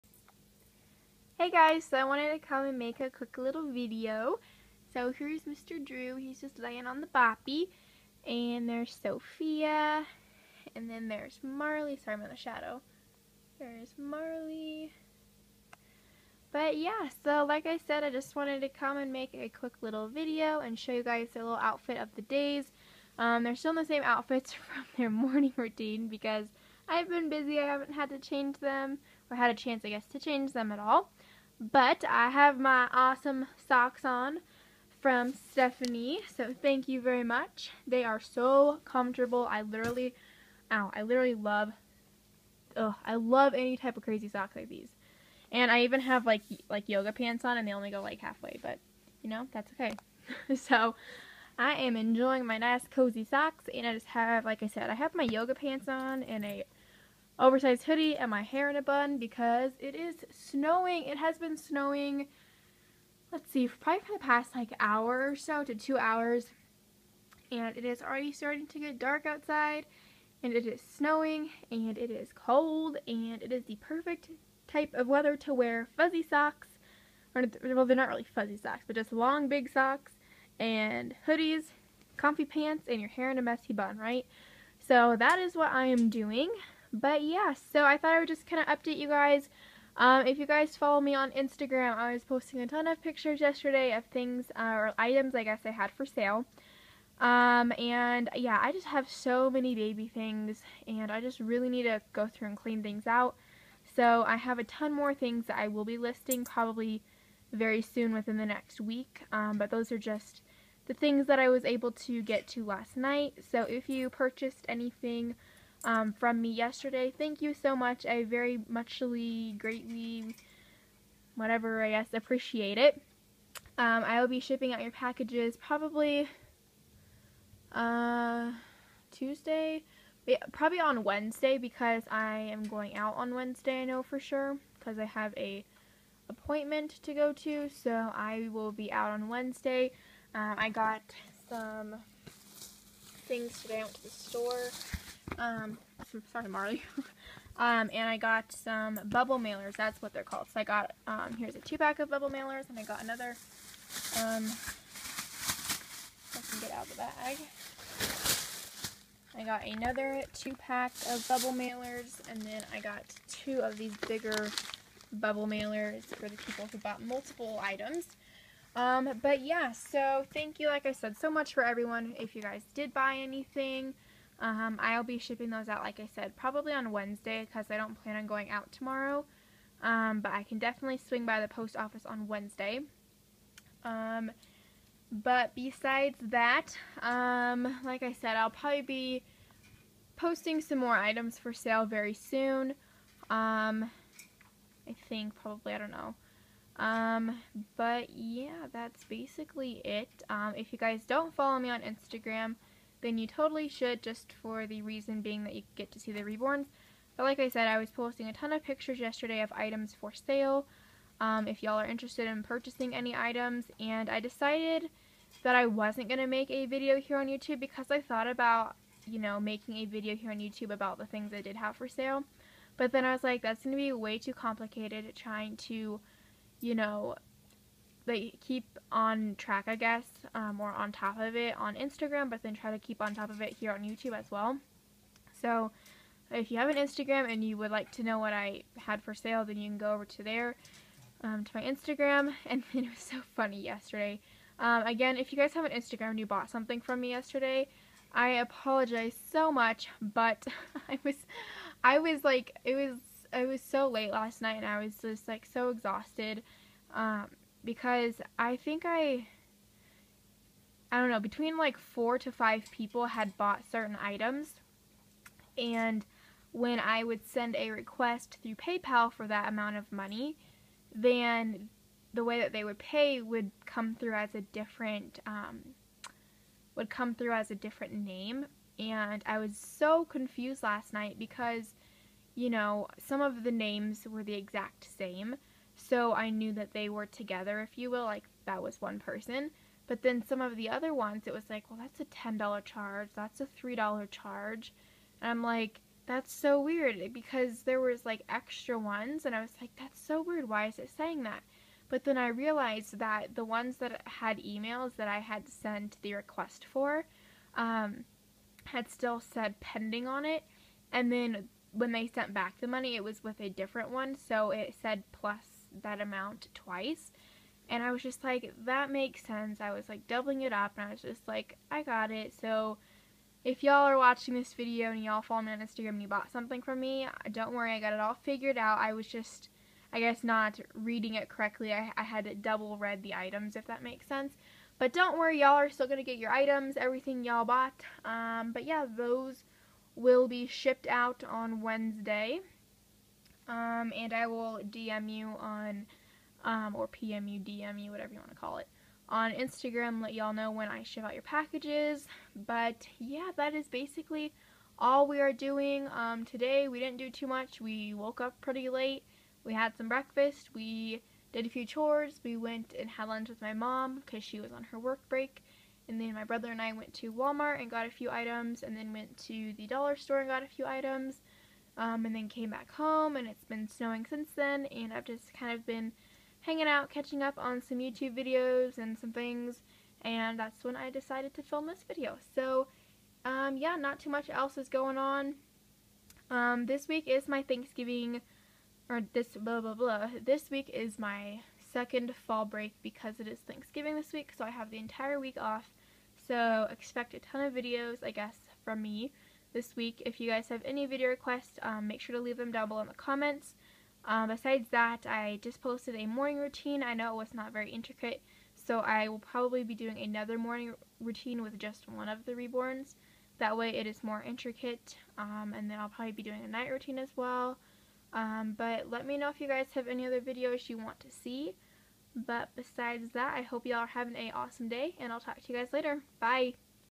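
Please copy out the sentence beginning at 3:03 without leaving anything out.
Um, but besides that, um, like I said, I'll probably be posting some more items for sale very soon.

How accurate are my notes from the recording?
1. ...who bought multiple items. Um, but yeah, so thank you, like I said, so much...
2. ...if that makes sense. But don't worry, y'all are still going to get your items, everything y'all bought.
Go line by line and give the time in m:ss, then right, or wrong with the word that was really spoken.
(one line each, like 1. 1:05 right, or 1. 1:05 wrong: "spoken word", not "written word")
1. 2:46 right
2. 5:33 right.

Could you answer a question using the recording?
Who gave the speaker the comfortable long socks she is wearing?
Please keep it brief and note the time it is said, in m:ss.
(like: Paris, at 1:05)
Stephanie, at 0:35.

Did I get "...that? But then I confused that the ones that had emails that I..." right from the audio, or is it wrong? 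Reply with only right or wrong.
wrong.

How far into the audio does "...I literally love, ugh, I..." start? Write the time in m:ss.
0:40.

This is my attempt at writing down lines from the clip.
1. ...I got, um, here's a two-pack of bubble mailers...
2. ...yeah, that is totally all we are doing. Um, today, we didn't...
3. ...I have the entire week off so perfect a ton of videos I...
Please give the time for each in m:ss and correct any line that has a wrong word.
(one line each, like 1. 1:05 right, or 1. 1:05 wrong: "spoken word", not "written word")
1. 2:30 right
2. 5:52 wrong: "basically", not "totally"
3. 6:34 wrong: "expect", not "perfect".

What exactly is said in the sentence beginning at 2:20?
Um, I got some things today.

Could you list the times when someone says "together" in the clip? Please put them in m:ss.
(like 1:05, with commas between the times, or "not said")
4:47.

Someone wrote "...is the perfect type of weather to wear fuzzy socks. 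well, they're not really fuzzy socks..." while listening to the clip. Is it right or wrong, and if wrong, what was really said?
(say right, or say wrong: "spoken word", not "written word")
right.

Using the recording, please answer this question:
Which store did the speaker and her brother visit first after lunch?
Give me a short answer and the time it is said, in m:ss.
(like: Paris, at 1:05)
Walmart, at 6:07.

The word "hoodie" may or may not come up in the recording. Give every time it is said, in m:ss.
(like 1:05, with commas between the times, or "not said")
0:57, 1:21.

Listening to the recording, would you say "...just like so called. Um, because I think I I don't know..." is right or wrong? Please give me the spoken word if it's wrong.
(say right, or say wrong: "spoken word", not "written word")
wrong: "exhausted", not "called".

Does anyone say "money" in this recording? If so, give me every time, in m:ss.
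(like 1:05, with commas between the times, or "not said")
4:29, 5:12.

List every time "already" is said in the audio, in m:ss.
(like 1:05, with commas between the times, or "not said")
1:08.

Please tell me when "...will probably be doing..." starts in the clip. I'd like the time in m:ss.
6:49.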